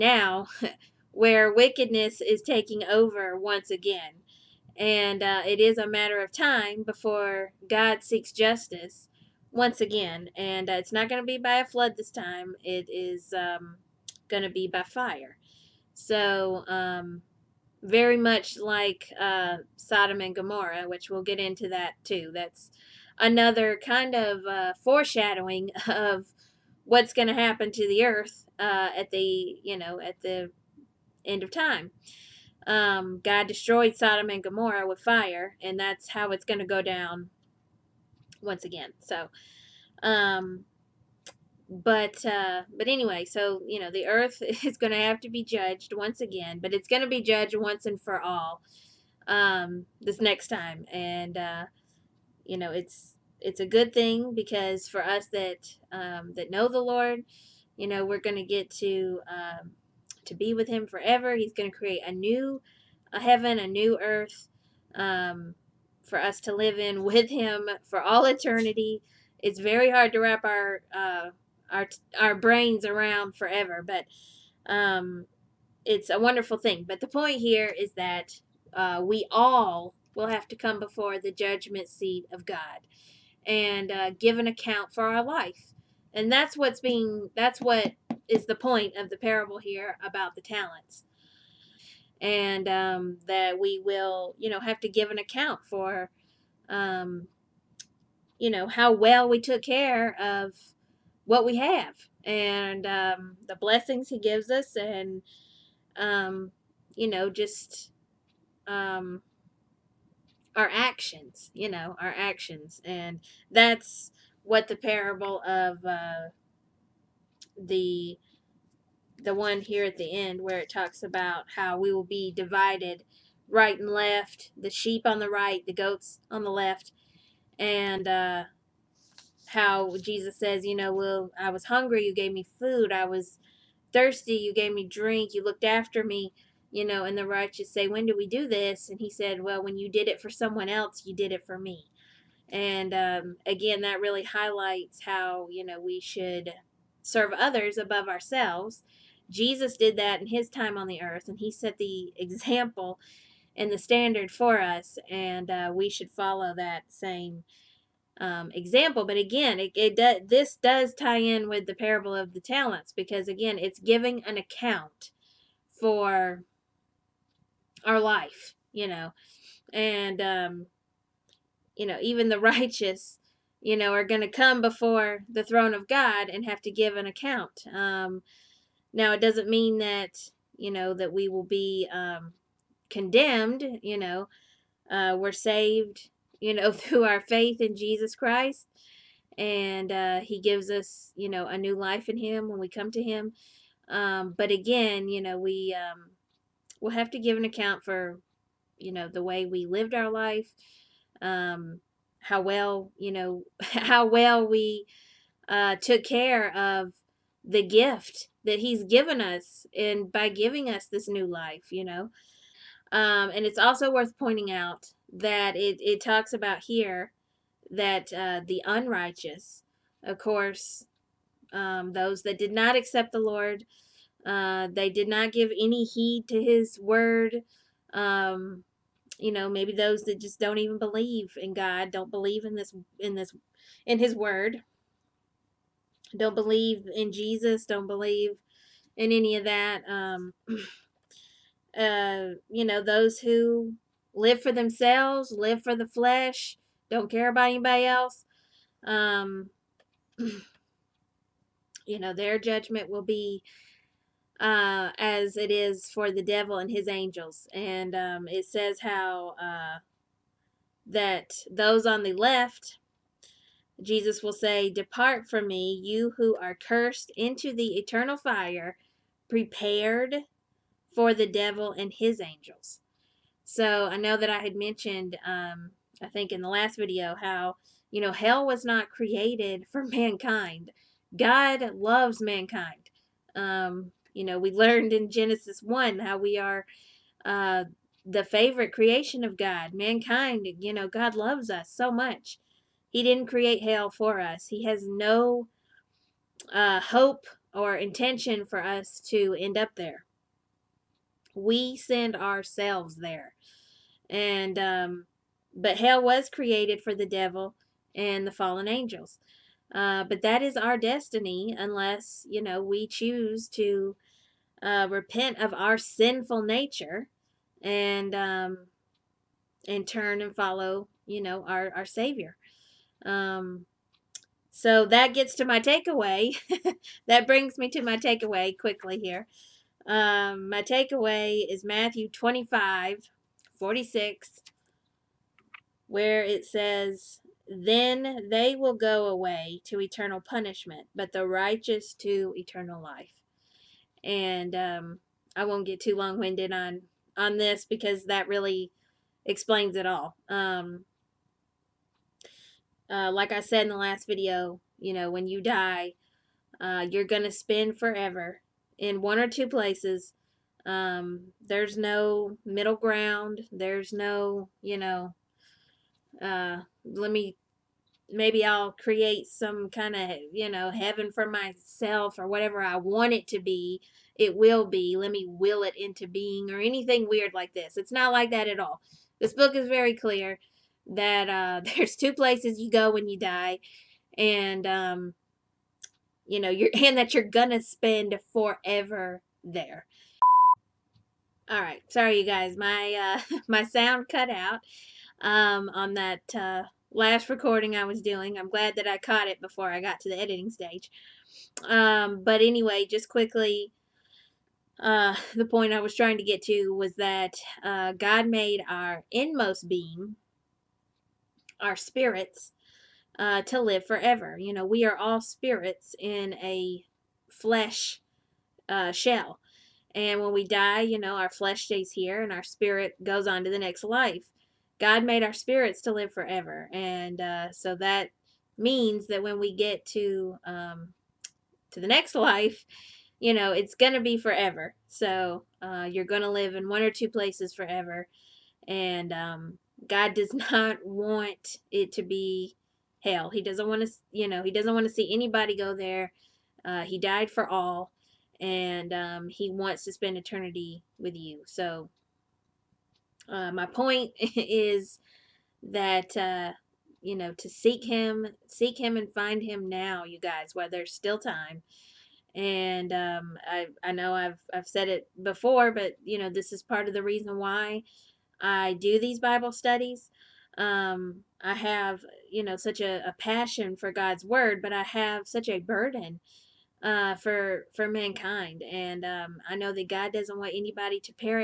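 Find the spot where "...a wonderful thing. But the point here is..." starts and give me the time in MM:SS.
01:16.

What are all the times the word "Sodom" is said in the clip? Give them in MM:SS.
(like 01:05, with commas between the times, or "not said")
00:19, 00:33.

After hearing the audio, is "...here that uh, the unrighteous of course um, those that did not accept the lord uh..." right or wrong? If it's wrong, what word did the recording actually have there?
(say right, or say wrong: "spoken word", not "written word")
right.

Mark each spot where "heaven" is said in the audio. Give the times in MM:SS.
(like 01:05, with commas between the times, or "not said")
01:03, 06:10.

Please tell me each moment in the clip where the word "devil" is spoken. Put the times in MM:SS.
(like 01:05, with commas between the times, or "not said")
04:16, 04:31, 05:07.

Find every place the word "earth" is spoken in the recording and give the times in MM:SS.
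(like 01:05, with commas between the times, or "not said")
00:28, 00:44, 01:04, 02:31.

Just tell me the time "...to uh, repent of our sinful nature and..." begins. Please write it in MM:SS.
05:13.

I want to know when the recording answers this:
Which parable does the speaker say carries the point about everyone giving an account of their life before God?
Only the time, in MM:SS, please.
01:29.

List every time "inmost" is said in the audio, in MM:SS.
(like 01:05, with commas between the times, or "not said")
06:49.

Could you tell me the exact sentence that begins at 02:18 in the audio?
And he said, well, when you did it for someone else, you did it for me.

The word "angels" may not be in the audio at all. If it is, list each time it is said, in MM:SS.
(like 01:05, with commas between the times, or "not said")
04:16, 04:32, 05:08.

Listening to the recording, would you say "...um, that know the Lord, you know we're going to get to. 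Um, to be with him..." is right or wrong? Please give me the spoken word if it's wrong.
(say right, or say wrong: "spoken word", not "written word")
right.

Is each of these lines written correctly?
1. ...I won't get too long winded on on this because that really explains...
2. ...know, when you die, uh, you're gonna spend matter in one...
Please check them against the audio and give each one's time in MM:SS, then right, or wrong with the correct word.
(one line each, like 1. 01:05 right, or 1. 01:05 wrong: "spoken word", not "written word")
1. 05:45 right
2. 05:54 wrong: "forever", not "matter".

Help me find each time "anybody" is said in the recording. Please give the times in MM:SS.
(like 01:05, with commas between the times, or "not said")
04:07, 07:25, 08:00.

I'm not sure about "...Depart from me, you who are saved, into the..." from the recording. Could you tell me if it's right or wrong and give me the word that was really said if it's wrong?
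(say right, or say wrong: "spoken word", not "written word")
wrong: "cursed", not "saved".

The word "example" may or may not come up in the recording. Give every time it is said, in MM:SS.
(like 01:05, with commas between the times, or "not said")
02:32, 02:38.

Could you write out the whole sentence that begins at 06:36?
Uh, last recording I was doing.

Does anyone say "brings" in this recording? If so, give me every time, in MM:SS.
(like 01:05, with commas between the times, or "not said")
05:27.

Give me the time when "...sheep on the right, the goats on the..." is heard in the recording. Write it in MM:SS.
02:04.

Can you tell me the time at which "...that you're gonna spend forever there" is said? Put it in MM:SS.
06:26.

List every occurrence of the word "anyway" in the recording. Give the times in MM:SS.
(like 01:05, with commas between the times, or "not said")
00:42, 06:42.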